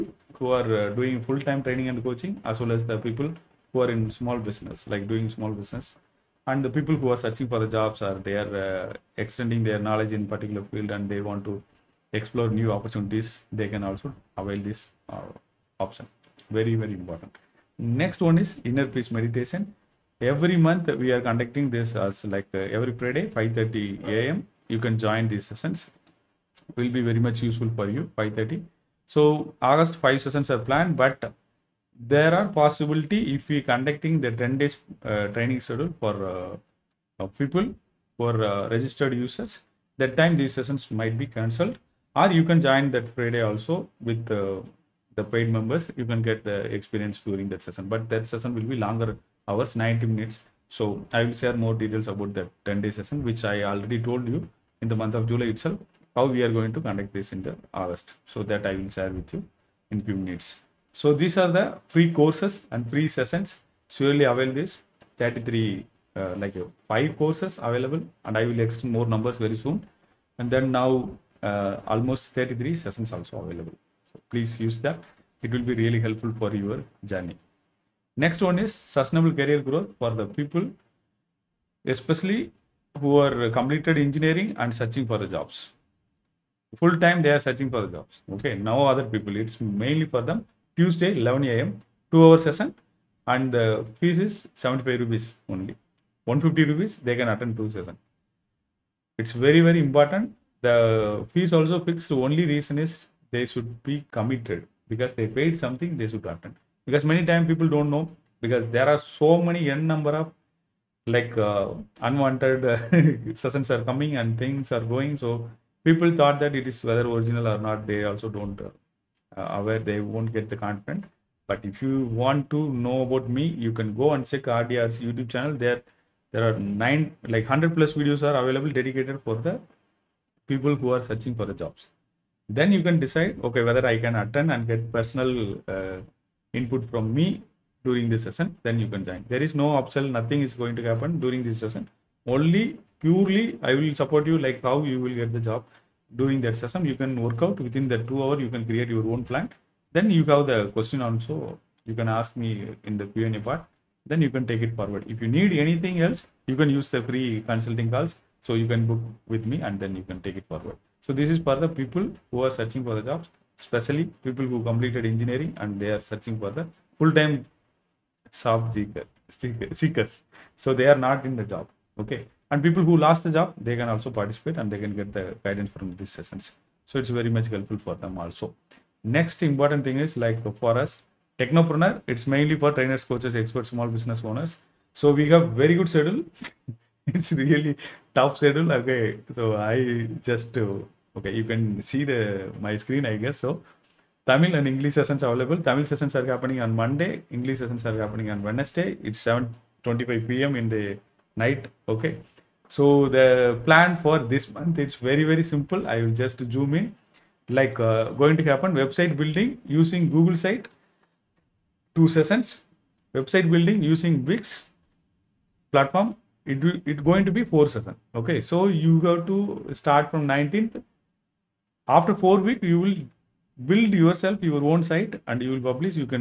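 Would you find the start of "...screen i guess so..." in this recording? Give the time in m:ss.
3:12.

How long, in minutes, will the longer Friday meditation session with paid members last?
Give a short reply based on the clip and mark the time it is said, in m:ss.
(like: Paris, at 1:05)
90 minutes, at 0:49.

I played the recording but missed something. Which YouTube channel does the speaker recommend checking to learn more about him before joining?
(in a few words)
RDRC.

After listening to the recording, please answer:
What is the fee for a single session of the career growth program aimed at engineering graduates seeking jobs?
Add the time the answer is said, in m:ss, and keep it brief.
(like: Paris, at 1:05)
75 rupees, at 1:34.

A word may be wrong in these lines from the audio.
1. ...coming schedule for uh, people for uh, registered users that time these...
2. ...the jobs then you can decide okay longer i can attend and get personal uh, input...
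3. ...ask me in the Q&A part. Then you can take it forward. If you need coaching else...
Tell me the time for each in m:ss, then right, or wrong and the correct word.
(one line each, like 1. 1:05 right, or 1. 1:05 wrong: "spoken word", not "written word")
1. 0:35 wrong: "training", not "coming"
2. 2:11 wrong: "whether", not "longer"
3. 2:32 wrong: "anything", not "coaching".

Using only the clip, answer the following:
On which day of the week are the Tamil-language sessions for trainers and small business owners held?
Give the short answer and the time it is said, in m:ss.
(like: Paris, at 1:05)
Monday, at 3:16.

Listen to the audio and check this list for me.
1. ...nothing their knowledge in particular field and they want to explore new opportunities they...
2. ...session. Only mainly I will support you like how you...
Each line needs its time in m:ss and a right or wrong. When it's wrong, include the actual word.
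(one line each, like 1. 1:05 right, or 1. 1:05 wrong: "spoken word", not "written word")
1. 0:09 wrong: "extending", not "nothing"
2. 2:21 wrong: "purely", not "mainly".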